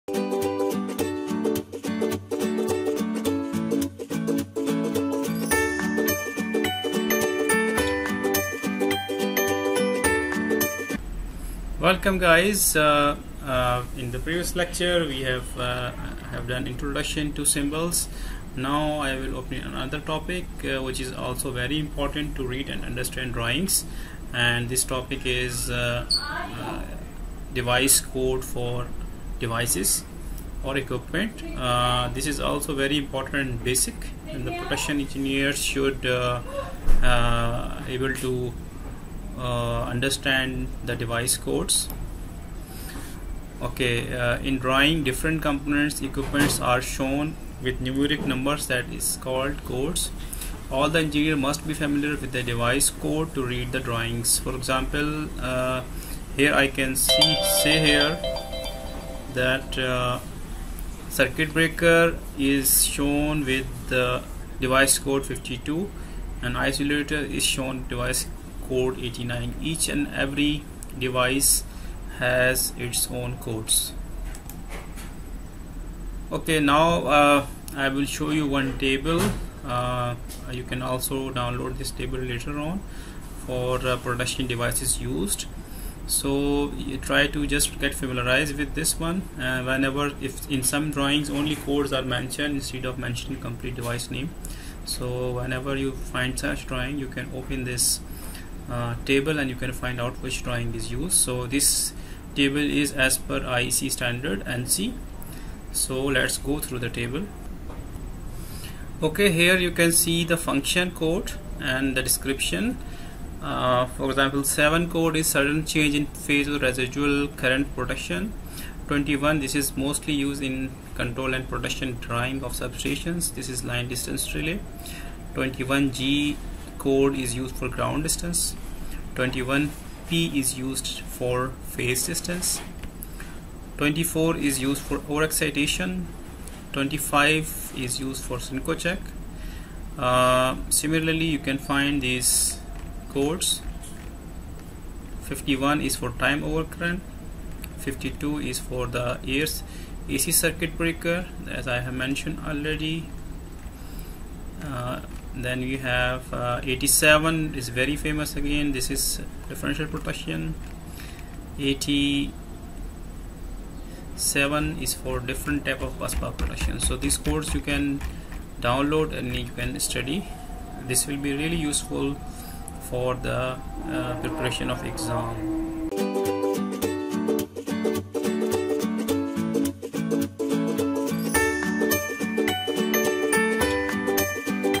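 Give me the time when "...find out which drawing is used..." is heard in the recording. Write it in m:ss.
1:39.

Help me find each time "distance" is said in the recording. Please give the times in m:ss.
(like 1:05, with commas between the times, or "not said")
2:03, 2:08, 2:12.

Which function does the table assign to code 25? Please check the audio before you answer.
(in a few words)
Synchrocheck.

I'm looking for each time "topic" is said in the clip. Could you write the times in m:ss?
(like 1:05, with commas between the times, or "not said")
0:19, 0:24.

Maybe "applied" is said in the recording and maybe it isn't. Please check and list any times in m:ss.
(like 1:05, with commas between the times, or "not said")
not said.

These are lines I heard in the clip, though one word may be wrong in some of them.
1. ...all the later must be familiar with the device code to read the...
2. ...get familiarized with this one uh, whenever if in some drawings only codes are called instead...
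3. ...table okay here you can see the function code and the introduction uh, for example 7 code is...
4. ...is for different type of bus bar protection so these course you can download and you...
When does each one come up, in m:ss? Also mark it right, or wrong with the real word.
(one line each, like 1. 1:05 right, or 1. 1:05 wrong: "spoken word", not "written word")
1. 0:50 wrong: "engineer", not "later"
2. 1:27 wrong: "mentioned", not "called"
3. 1:46 wrong: "description", not "introduction"
4. 2:44 right.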